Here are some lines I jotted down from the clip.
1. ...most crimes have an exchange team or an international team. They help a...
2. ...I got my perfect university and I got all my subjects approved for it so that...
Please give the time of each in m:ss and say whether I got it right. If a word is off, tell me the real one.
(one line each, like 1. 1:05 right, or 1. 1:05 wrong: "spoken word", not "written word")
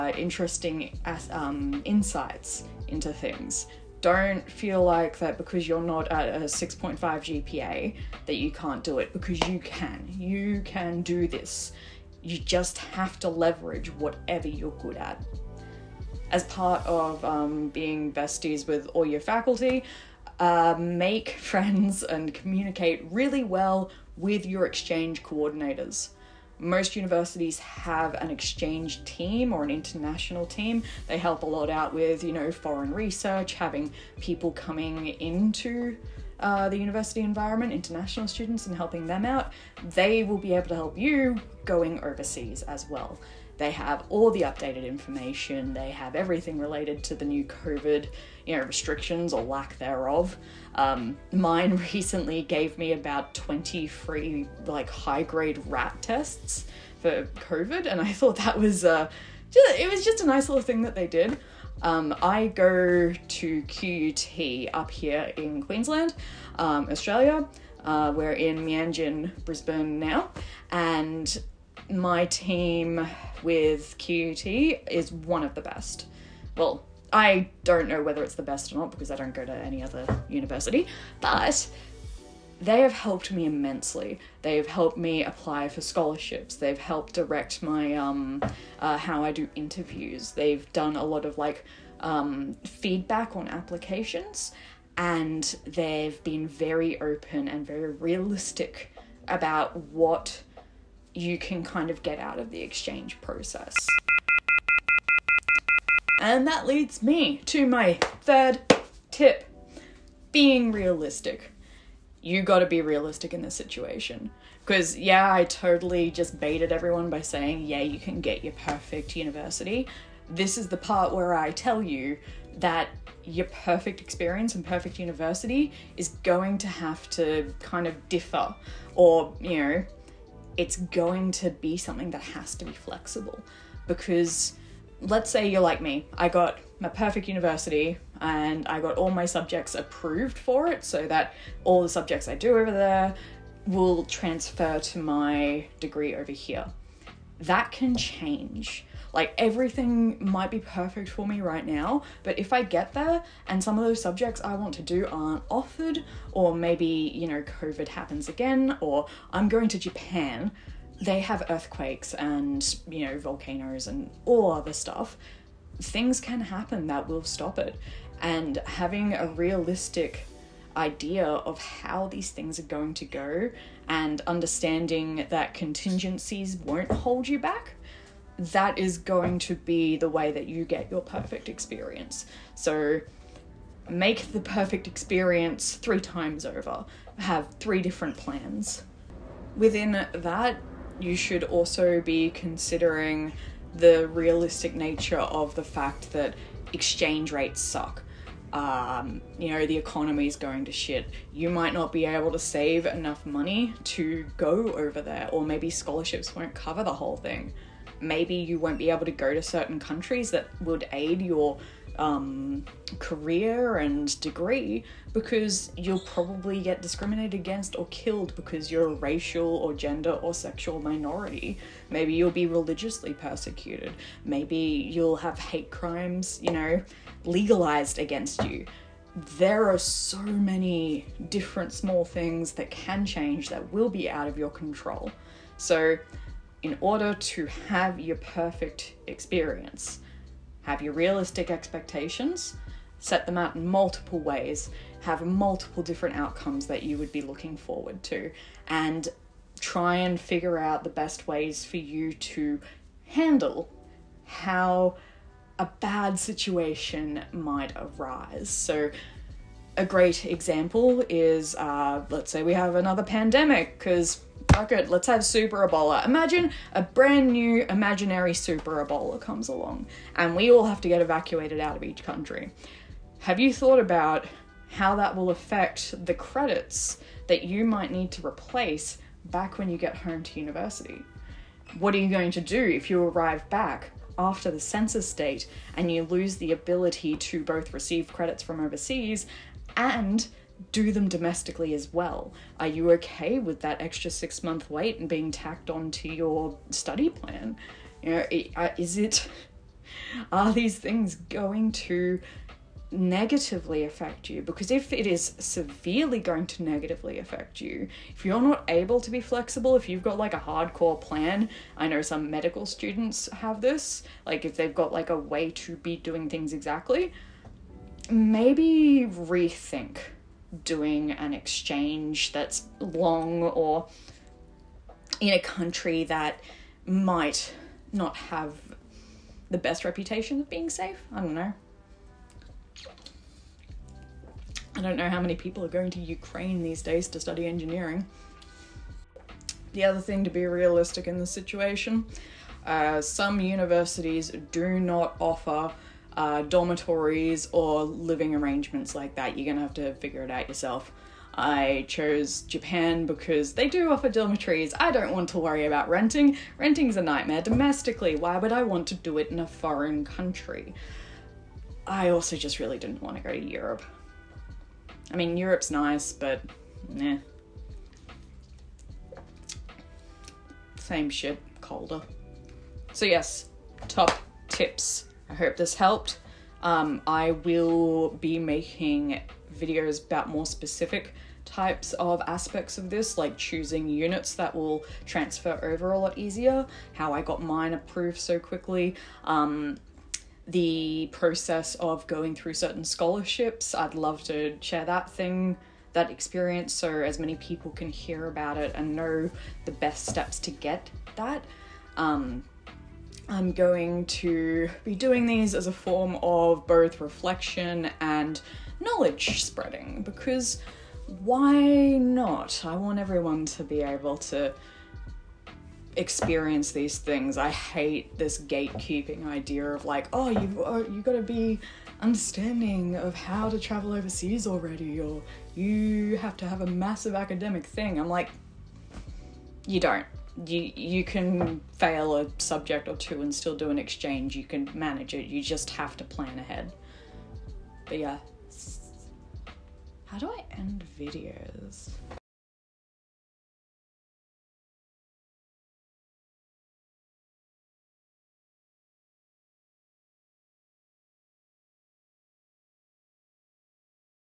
1. 0:26 wrong: "universities", not "crimes"
2. 2:16 right.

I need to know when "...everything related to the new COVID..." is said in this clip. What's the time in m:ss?
0:46.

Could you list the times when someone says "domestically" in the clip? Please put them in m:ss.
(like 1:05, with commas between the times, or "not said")
4:51, 5:57.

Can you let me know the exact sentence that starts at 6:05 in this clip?
I mean, Europe's nice, but nah.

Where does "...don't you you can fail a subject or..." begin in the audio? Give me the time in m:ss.
7:09.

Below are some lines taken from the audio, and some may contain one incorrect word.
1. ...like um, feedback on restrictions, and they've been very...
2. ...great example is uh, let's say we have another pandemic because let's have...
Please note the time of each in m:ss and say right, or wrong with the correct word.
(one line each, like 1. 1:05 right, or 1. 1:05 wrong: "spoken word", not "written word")
1. 1:31 wrong: "applications", not "restrictions"
2. 4:19 right.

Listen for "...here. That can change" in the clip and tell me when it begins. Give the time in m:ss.
2:26.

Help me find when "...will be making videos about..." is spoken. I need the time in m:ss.
6:17.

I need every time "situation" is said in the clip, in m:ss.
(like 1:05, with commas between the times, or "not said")
1:53, 4:16, 5:41.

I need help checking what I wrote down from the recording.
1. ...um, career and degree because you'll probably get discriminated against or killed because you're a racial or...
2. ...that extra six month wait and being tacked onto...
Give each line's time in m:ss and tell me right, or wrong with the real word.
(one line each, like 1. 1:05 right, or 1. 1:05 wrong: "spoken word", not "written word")
1. 3:31 right
2. 4:53 right.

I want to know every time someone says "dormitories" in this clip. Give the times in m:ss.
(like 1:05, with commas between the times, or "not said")
5:46, 5:54.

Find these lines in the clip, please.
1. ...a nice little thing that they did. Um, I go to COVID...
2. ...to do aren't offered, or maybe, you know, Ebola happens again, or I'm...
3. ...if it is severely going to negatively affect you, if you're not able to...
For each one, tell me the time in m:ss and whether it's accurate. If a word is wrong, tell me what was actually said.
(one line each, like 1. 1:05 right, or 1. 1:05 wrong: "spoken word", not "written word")
1. 1:00 wrong: "QUT", not "COVID"
2. 2:34 wrong: "COVID", not "Ebola"
3. 5:04 right.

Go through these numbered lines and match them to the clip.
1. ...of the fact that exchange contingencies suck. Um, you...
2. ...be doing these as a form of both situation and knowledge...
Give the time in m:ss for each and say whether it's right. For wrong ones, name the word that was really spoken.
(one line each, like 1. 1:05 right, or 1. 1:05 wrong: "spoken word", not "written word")
1. 3:15 wrong: "rates", not "contingencies"
2. 6:44 wrong: "reflection", not "situation".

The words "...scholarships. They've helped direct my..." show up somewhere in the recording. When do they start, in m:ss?
1:25.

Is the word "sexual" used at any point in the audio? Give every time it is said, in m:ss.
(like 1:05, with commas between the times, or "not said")
3:40.